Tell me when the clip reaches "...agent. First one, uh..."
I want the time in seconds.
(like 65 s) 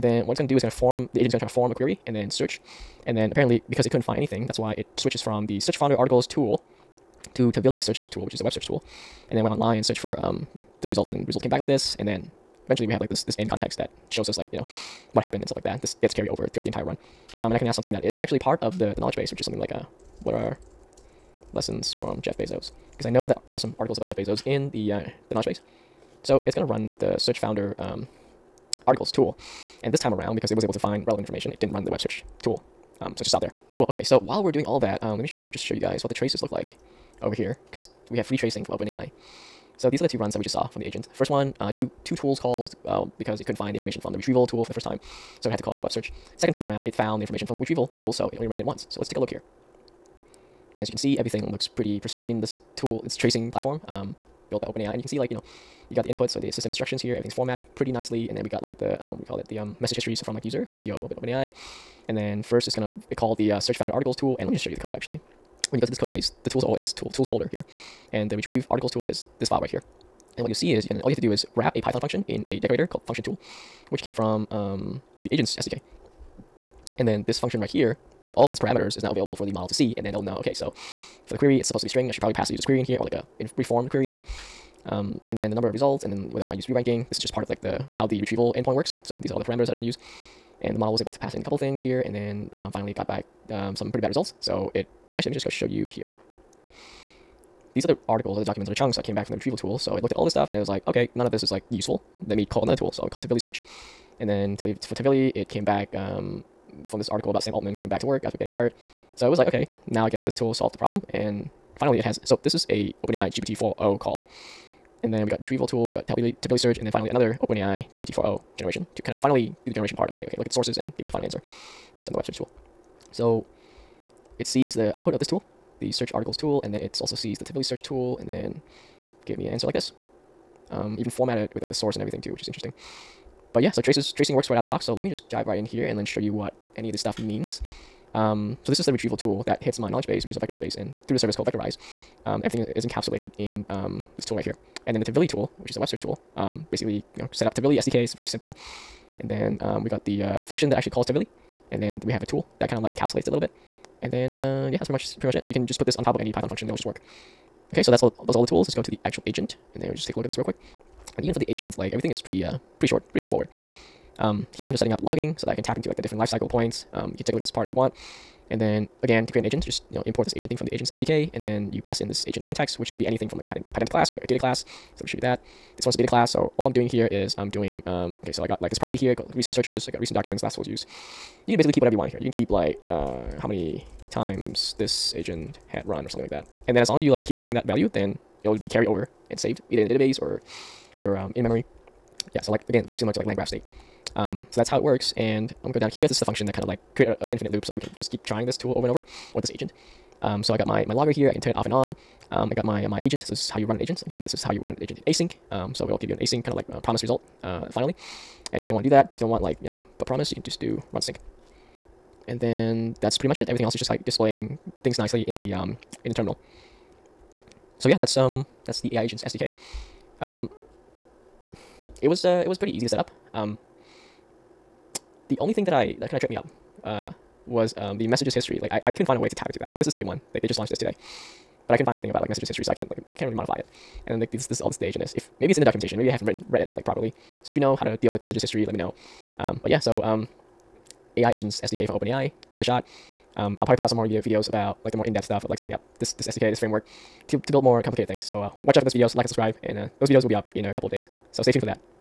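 40 s.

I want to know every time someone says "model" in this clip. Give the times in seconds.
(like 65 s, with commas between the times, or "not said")
79 s, 90 s.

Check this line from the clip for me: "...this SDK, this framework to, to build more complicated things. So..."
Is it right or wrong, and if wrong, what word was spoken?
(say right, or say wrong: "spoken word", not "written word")
right.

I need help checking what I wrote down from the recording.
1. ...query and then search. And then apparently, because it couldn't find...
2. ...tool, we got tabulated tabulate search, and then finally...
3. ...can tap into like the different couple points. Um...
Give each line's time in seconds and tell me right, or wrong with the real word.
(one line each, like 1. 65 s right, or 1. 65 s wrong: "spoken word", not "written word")
1. 1 s right
2. 115 s right
3. 165 s wrong: "lifecycle", not "couple".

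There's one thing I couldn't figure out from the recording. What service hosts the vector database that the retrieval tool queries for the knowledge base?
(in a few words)
Vectorize.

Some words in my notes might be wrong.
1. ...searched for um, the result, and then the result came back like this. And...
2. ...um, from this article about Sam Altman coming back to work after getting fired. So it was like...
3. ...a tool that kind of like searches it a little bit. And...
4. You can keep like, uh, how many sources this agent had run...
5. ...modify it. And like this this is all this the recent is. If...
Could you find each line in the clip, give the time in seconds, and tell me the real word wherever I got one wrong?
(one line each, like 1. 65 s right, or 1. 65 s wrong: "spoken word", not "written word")
1. 9 s right
2. 105 s right
3. 152 s wrong: "encapsulates", not "searches"
4. 182 s wrong: "times", not "sources"
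5. 233 s wrong: "agent", not "recent".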